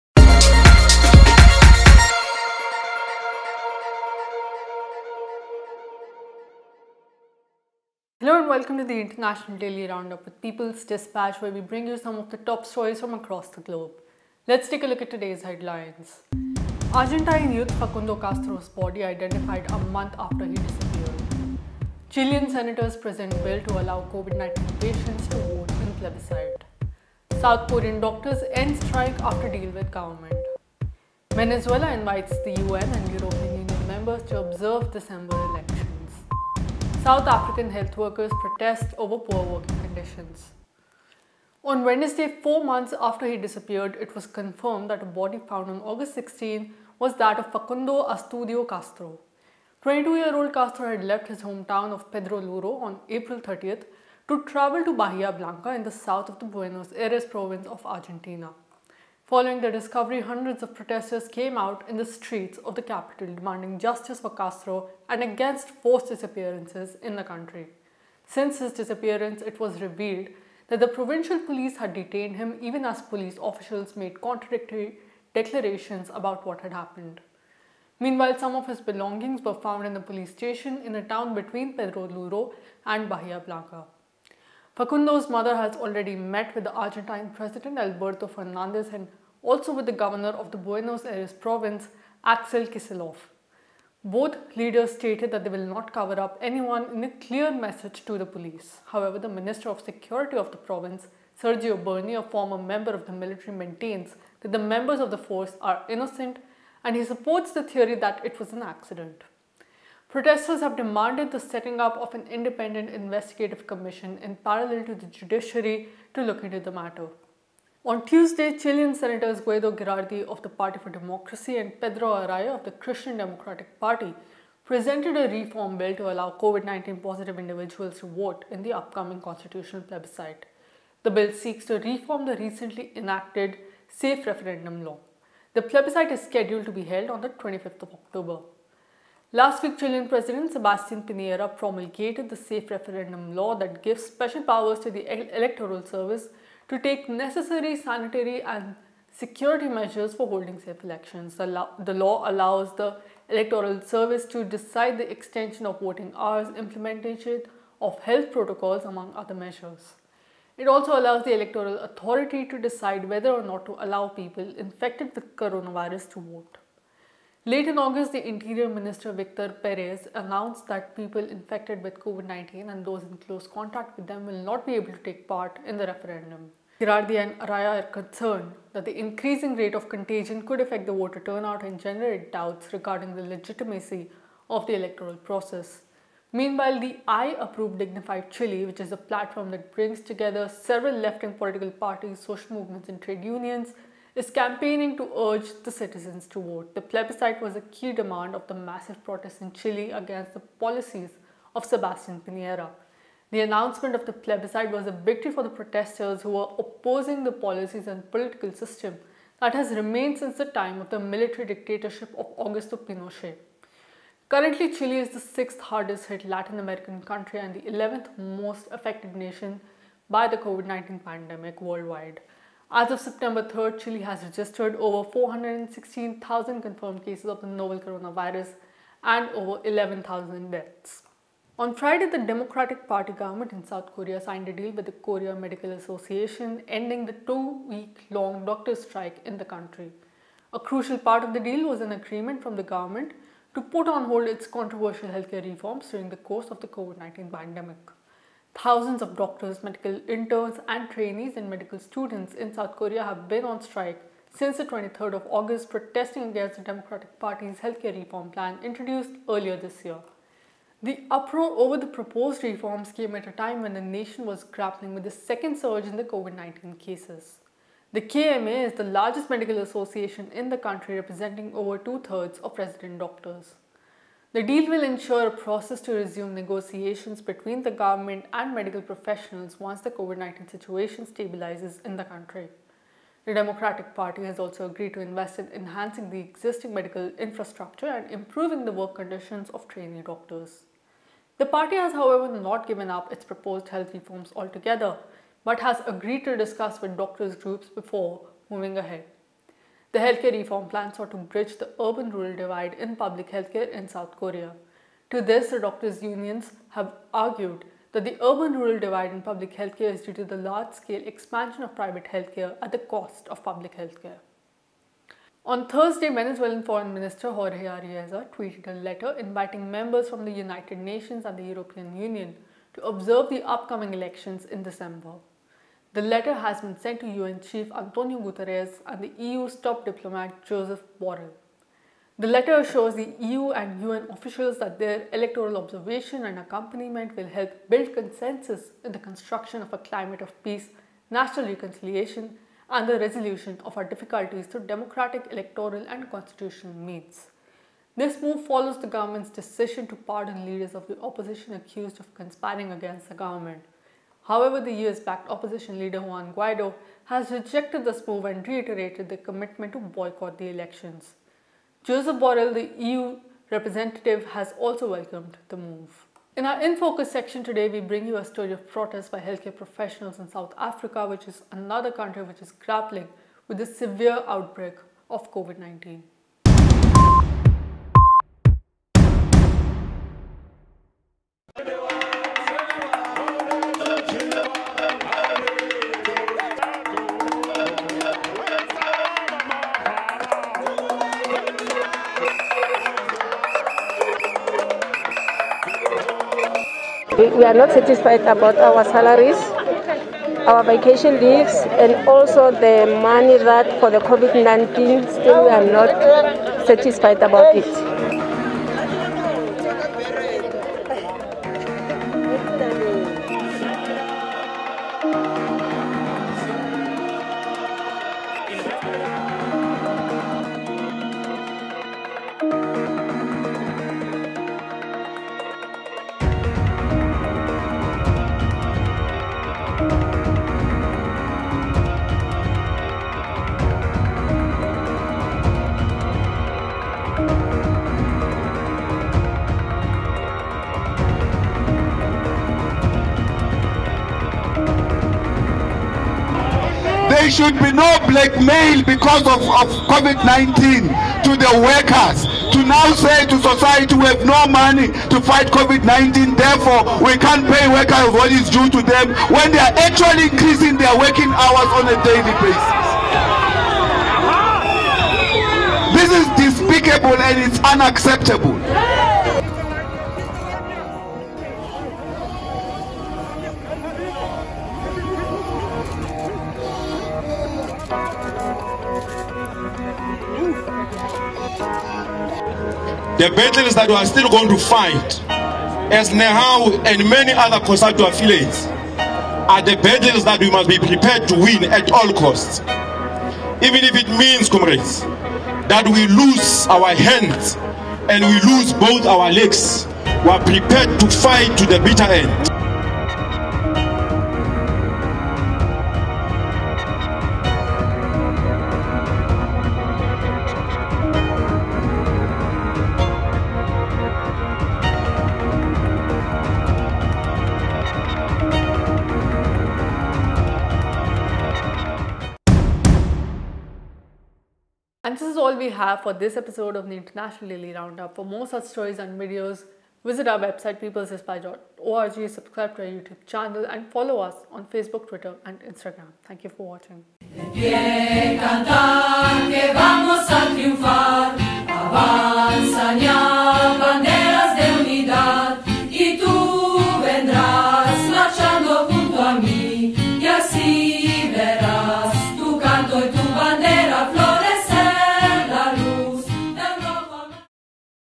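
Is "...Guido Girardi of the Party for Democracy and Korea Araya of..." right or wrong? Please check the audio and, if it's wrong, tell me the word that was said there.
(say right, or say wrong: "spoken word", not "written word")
wrong: "Pedro", not "Korea".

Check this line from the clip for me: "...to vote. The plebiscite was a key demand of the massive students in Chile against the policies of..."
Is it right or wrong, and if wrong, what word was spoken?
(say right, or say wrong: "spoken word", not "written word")
wrong: "protests", not "students".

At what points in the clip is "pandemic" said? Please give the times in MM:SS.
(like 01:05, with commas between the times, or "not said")
03:40, 04:07.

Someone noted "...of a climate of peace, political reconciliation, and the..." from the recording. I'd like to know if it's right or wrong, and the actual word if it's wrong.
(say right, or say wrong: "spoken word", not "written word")
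wrong: "national", not "political".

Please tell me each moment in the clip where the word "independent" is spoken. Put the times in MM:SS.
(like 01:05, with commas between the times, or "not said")
01:52.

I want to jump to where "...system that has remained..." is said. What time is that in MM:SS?
03:28.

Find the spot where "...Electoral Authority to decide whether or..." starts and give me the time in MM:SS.
02:41.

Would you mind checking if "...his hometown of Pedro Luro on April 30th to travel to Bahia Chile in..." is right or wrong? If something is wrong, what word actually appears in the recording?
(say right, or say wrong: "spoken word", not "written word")
wrong: "Blanca", not "Chile".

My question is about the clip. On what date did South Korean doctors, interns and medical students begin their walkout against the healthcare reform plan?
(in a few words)
23rd of August.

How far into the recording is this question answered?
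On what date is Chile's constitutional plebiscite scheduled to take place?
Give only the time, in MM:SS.
02:17.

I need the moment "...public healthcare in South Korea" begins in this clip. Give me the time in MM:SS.
05:02.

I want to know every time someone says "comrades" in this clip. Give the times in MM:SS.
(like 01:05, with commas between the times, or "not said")
08:14.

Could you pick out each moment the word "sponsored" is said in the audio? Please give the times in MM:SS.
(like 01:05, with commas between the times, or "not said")
not said.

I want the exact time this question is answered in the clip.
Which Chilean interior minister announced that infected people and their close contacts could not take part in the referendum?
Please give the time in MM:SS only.
02:49.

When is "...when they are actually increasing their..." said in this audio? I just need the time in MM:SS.
07:39.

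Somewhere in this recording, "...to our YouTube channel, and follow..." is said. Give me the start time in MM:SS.
08:52.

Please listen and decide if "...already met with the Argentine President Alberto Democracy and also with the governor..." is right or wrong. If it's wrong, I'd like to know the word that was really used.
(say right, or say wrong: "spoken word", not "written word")
wrong: "Fernandez", not "Democracy".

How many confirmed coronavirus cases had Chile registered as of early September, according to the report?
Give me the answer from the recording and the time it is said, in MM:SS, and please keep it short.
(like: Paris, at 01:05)
over 416,000, at 03:44.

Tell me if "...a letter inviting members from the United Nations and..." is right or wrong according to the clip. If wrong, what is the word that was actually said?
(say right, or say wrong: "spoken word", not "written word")
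right.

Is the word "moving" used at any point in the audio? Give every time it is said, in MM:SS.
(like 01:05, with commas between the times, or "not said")
04:58.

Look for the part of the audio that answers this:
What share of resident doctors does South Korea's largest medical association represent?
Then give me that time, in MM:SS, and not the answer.
04:31.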